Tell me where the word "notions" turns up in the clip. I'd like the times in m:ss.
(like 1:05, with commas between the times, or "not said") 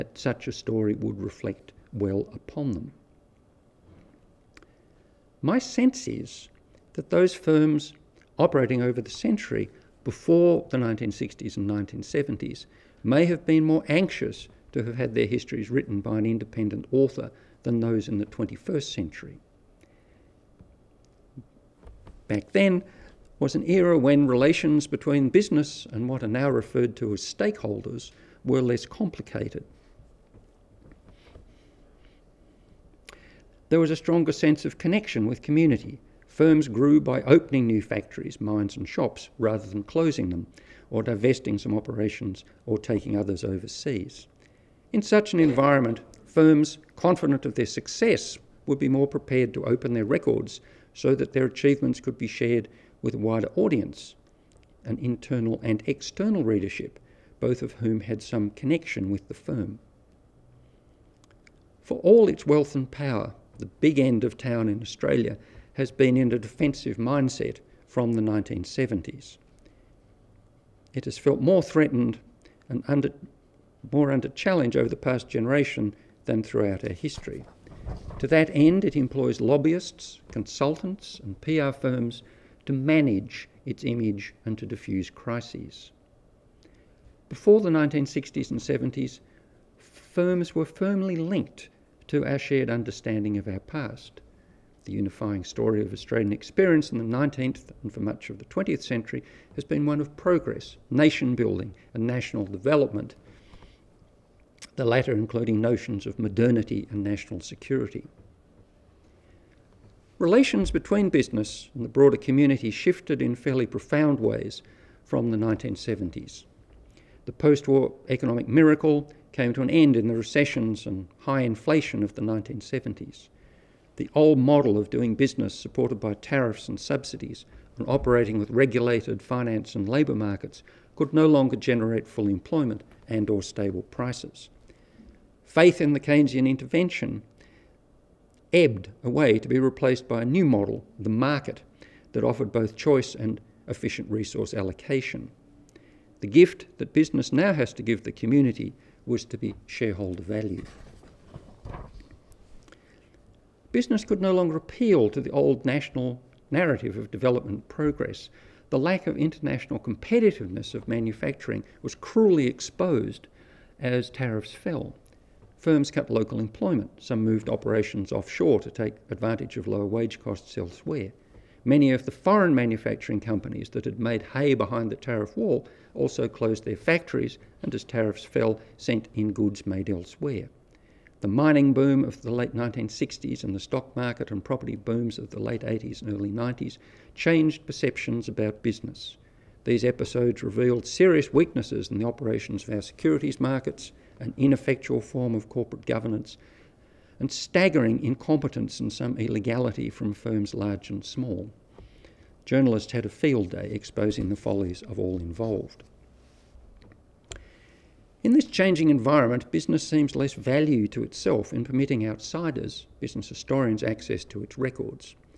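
1:45.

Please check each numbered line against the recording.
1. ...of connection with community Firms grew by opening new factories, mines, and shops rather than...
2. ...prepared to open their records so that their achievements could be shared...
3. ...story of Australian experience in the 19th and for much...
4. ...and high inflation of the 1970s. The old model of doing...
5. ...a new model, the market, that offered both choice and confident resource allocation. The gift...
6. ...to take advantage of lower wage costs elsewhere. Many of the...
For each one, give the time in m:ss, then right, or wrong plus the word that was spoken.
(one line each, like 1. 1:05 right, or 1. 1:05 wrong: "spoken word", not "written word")
1. 0:34 right
2. 0:49 right
3. 1:35 right
4. 2:00 right
5. 2:20 wrong: "efficient", not "confident"
6. 2:48 right.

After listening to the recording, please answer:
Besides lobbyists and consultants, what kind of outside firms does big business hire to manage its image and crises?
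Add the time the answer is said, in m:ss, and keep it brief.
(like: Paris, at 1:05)
PR firms, at 1:21.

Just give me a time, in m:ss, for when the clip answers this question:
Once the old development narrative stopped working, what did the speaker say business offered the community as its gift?
2:29.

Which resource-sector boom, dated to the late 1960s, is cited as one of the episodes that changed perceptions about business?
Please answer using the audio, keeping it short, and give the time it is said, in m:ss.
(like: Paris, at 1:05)
mining boom, at 3:01.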